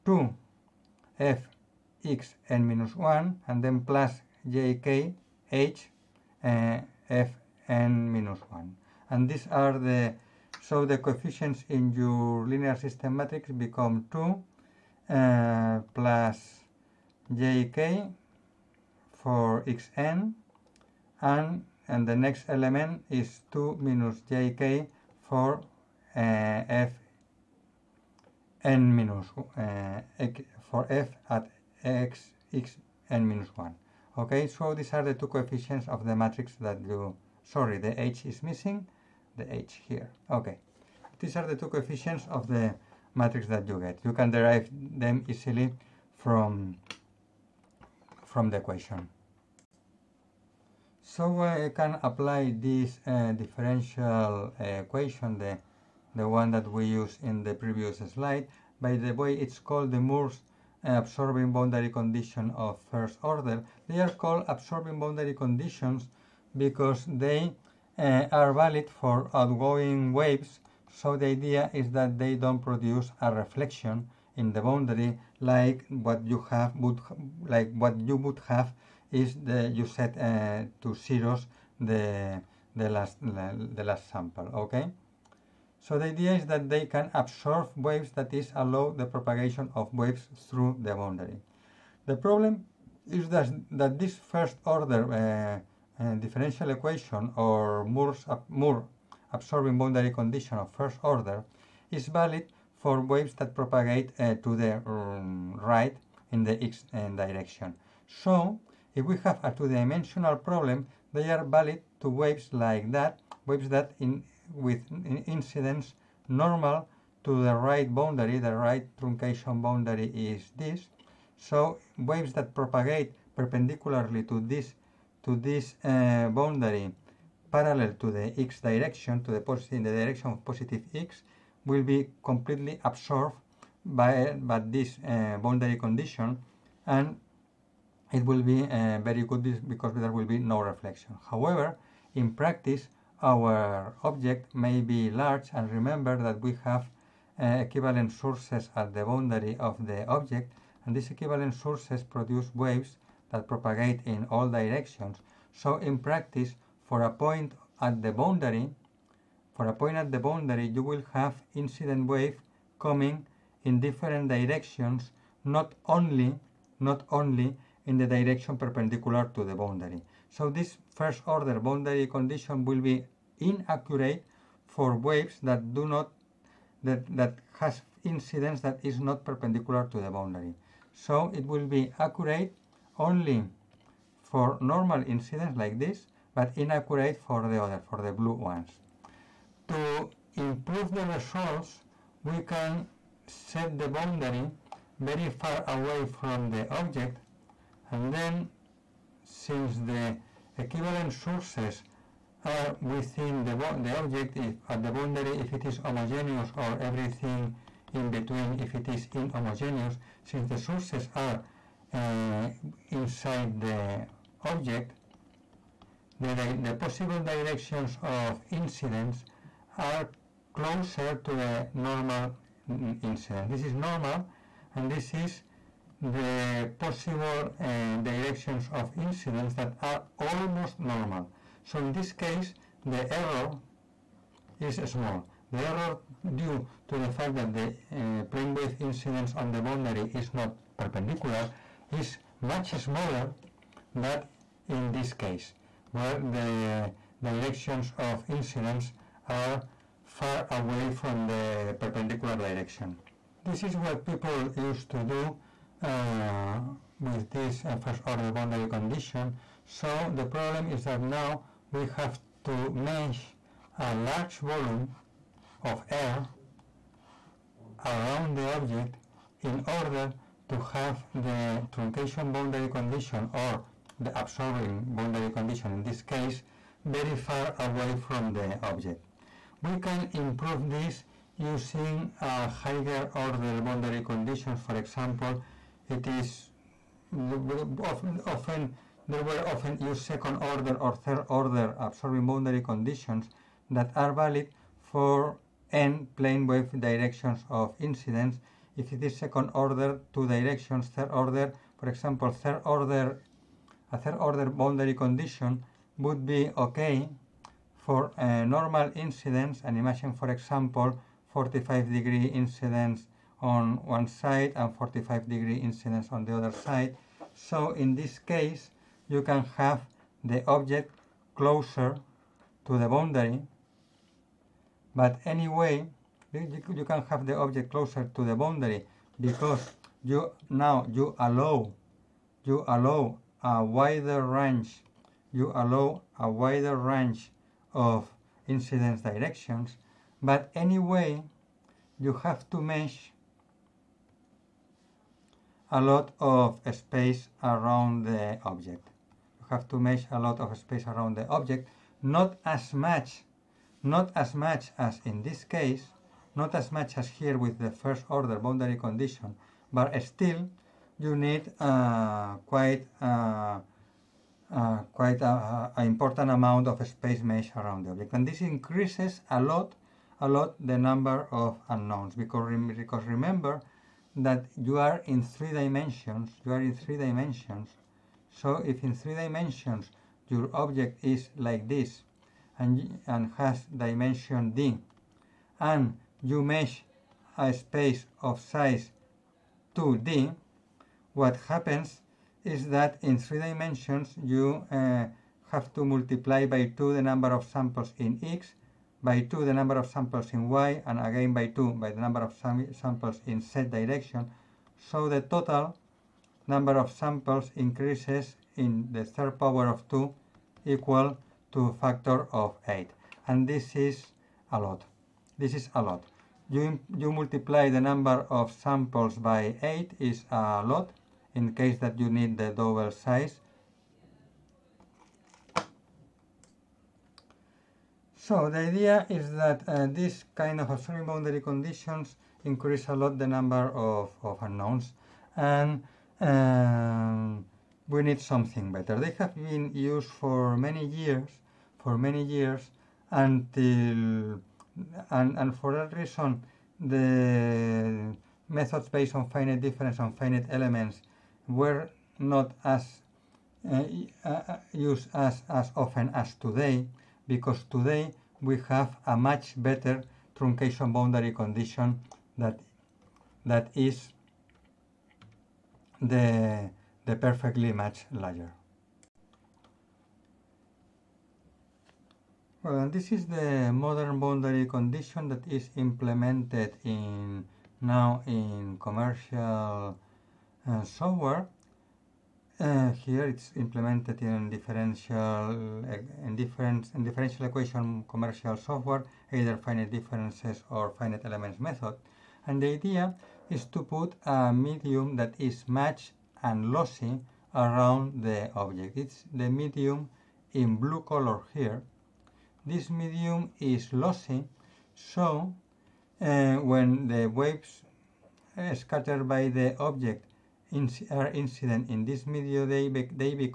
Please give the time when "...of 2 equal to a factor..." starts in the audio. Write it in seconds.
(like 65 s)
409 s.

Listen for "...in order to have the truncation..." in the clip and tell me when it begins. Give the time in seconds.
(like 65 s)
269 s.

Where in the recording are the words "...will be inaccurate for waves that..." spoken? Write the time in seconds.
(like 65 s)
172 s.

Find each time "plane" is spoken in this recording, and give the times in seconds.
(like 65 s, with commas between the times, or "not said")
238 s, 296 s.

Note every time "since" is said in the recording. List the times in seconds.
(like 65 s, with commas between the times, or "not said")
199 s, 210 s.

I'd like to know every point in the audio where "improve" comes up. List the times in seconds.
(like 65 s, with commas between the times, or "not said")
190 s, 280 s.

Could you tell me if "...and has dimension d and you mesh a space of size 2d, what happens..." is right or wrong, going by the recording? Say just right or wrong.
right.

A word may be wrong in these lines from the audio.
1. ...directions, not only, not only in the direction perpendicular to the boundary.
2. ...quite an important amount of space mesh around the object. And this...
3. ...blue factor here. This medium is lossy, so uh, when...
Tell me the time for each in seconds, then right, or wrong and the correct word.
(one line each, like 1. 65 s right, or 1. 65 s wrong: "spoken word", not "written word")
1. 164 s right
2. 364 s right
3. 500 s wrong: "color", not "factor".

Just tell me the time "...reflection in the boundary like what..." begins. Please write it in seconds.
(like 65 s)
73 s.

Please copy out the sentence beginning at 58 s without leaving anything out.
By the way, it's called the Mur's absorbing boundary condition of first order.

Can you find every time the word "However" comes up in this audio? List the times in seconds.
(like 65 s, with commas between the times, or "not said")
141 s.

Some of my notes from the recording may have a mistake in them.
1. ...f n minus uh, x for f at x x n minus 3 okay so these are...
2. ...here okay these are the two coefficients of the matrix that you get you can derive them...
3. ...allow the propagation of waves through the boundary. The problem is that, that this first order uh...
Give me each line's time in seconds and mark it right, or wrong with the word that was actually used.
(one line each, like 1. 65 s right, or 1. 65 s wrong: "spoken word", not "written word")
1. 26 s wrong: "1", not "3"
2. 39 s right
3. 88 s right.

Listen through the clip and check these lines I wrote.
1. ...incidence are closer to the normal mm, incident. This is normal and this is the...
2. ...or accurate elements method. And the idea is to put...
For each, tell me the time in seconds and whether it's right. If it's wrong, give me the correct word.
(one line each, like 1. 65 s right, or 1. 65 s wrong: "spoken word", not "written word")
1. 218 s right
2. 490 s wrong: "finite", not "accurate".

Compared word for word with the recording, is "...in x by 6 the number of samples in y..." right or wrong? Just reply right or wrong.
wrong.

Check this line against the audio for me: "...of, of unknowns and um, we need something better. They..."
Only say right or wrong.
right.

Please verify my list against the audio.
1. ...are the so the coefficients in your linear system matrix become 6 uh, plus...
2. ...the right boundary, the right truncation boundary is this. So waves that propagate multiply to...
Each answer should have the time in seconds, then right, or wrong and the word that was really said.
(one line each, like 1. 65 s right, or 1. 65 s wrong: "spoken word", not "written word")
1. 9 s wrong: "2", not "6"
2. 117 s wrong: "perpendicularly", not "multiply".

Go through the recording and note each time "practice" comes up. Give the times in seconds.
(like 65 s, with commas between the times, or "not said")
142 s, 155 s.